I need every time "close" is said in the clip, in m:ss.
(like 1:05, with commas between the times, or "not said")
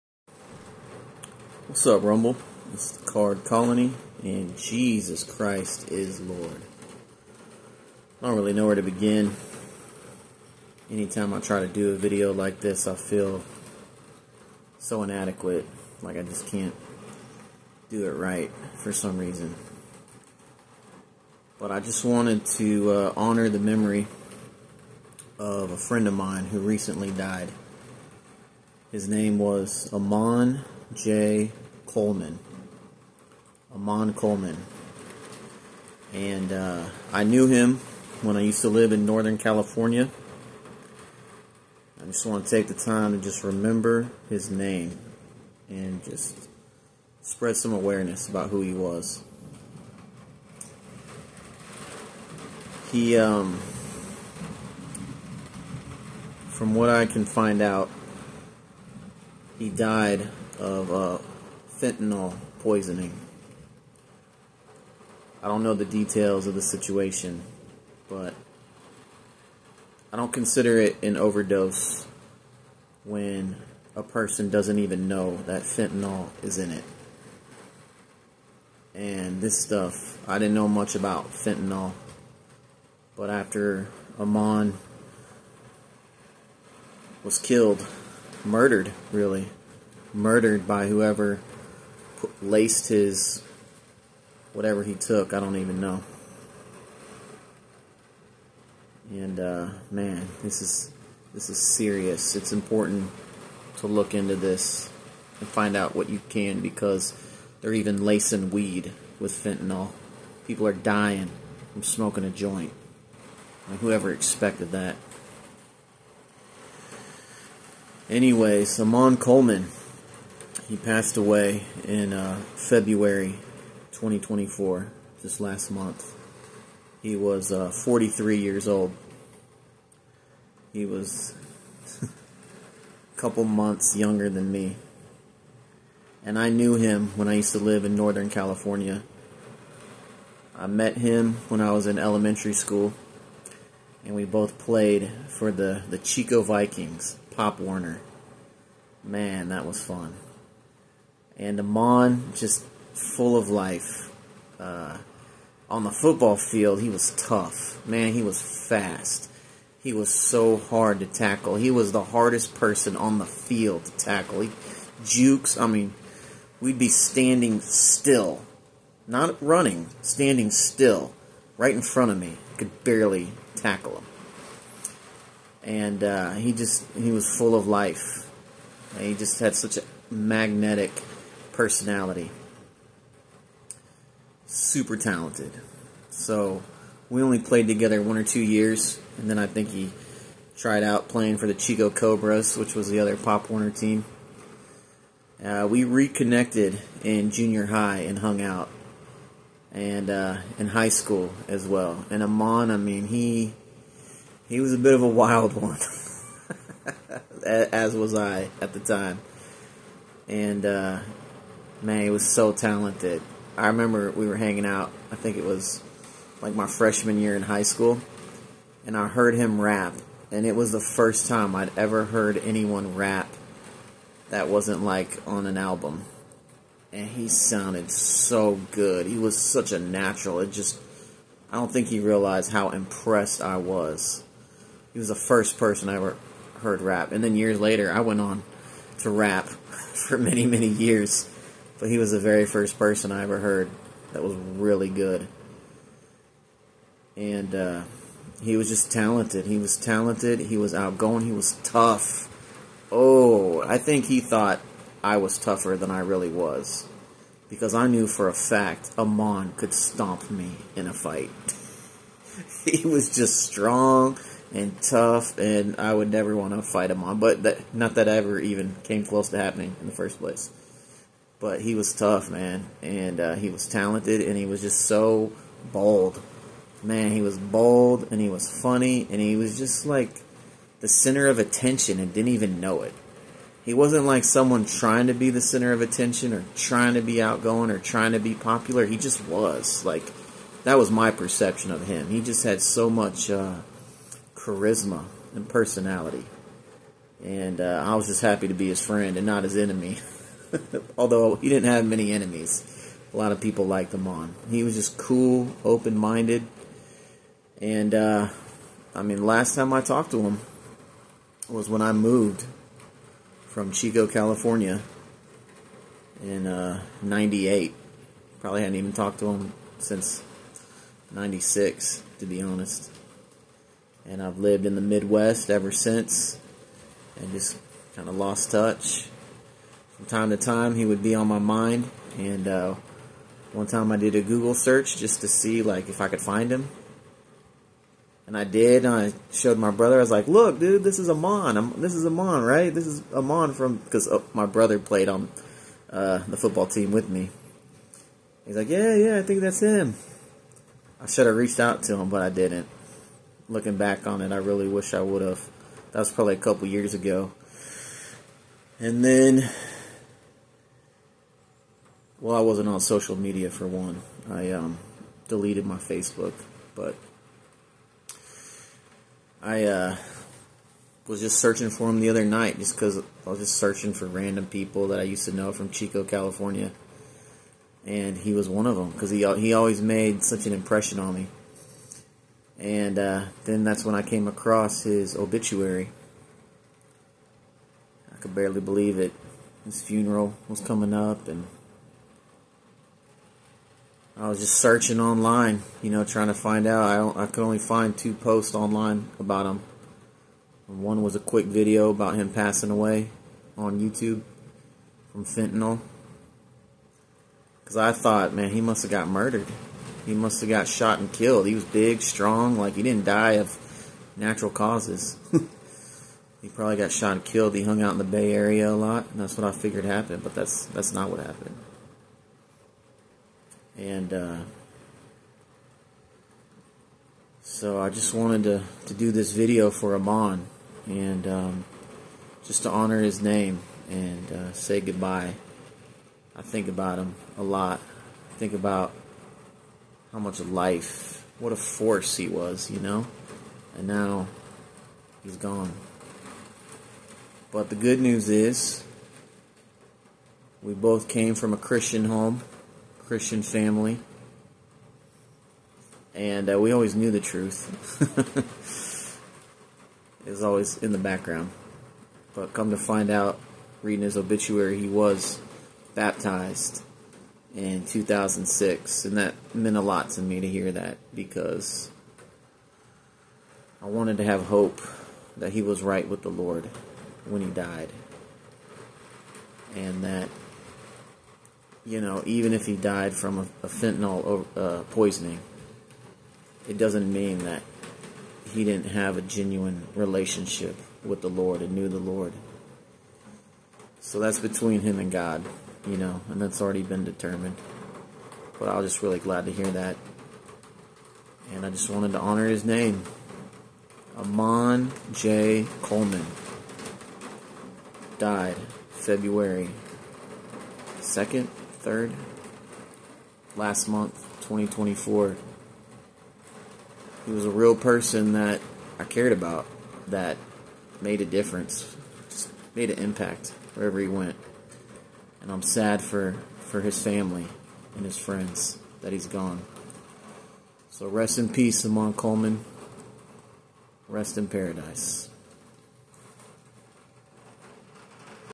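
4:29.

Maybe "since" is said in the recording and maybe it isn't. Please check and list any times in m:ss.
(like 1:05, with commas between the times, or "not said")
5:19, 5:25.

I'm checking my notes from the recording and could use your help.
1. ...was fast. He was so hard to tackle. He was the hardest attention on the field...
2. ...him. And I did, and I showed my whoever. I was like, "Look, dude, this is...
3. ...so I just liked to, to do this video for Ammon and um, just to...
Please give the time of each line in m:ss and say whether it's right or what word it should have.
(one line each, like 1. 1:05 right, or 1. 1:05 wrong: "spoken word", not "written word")
1. 2:38 wrong: "person", not "attention"
2. 5:36 wrong: "brother", not "whoever"
3. 7:07 wrong: "wanted", not "liked".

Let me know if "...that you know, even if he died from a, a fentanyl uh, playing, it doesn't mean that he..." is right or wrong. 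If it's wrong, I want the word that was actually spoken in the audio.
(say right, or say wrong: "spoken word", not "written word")
wrong: "poisoning", not "playing".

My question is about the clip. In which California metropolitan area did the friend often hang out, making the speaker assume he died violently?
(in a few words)
Bay Area.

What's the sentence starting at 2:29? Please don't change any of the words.
Man, that was fun and Ammon just full of life.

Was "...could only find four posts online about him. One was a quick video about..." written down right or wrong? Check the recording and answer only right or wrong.
wrong.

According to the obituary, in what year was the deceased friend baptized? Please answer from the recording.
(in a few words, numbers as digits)
2006.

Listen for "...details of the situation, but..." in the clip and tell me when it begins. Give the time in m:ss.
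1:05.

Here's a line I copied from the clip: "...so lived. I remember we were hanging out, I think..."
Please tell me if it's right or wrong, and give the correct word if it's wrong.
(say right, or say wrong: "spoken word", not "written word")
wrong: "talented", not "lived".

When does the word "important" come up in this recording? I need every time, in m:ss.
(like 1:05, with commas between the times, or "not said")
1:42.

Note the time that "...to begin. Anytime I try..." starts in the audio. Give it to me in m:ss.
0:08.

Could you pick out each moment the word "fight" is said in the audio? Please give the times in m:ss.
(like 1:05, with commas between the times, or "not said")
4:20, 4:26.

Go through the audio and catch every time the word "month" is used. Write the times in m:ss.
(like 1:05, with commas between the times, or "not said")
2:05, 2:13, 8:33.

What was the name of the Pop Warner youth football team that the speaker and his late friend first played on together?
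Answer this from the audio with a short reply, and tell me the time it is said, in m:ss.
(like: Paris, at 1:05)
Chico Vikings, at 2:25.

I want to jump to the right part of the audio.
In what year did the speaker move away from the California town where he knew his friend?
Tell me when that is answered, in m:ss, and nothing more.
5:17.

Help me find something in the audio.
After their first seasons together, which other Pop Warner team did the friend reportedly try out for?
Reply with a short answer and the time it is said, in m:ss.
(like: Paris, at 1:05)
Chico Cobras, at 3:11.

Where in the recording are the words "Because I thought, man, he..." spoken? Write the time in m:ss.
6:47.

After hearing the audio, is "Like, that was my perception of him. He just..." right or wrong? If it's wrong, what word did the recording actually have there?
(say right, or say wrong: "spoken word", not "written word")
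right.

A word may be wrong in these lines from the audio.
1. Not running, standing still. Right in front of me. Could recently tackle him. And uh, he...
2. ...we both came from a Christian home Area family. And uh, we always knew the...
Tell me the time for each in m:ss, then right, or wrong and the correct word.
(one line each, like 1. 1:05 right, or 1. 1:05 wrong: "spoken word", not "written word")
1. 2:49 wrong: "barely", not "recently"
2. 7:30 wrong: "Christian", not "Area".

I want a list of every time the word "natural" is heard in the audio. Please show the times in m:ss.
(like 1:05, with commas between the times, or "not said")
3:49, 6:54.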